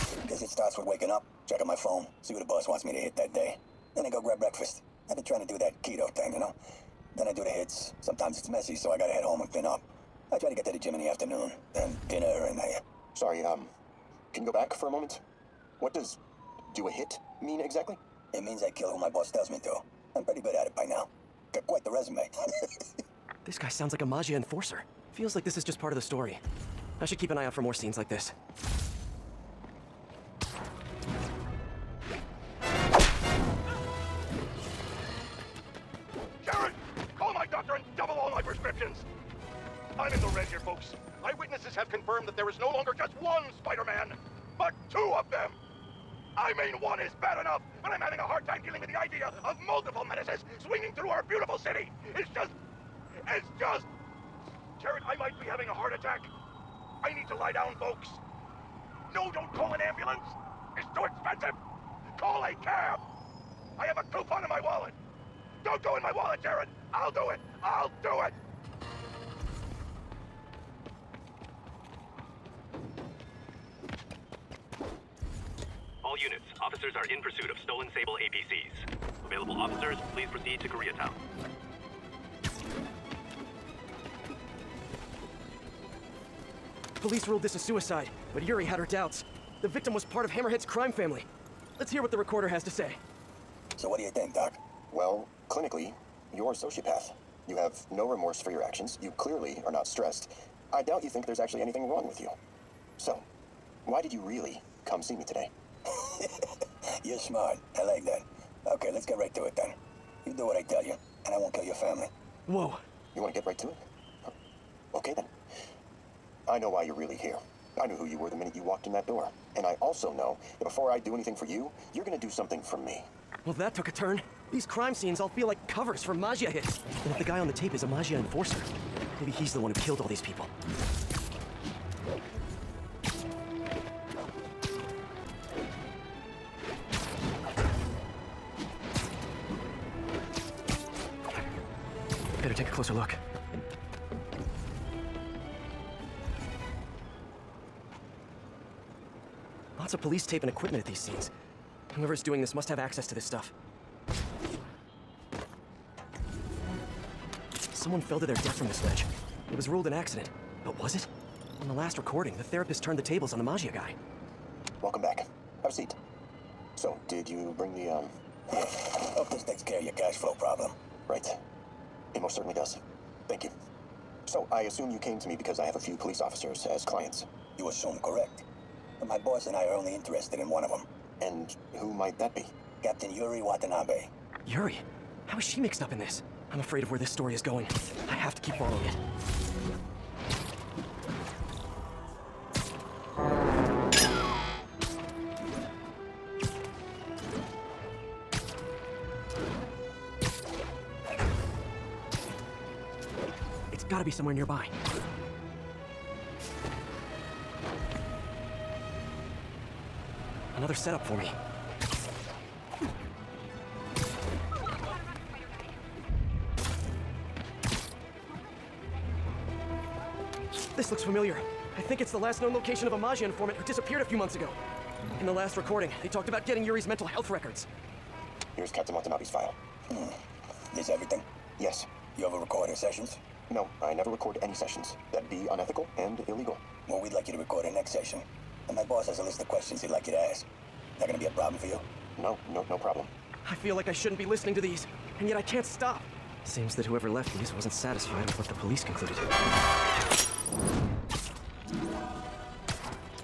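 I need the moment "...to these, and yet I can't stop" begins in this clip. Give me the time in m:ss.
4:04.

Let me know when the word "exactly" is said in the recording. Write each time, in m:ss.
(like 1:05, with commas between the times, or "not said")
0:17.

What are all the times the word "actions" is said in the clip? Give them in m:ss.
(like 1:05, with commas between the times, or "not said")
1:38.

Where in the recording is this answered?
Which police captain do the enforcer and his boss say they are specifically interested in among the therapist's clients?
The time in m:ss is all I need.
3:02.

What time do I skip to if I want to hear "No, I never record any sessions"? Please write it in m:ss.
3:53.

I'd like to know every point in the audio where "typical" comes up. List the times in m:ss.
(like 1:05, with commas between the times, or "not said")
not said.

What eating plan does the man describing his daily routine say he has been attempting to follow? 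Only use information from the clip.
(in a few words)
Keto.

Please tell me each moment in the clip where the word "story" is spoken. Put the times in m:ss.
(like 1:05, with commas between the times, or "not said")
0:26, 3:07.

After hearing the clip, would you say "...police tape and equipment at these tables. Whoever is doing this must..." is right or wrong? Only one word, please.
wrong.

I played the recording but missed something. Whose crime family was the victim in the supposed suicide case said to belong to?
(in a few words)
Hammerhead's.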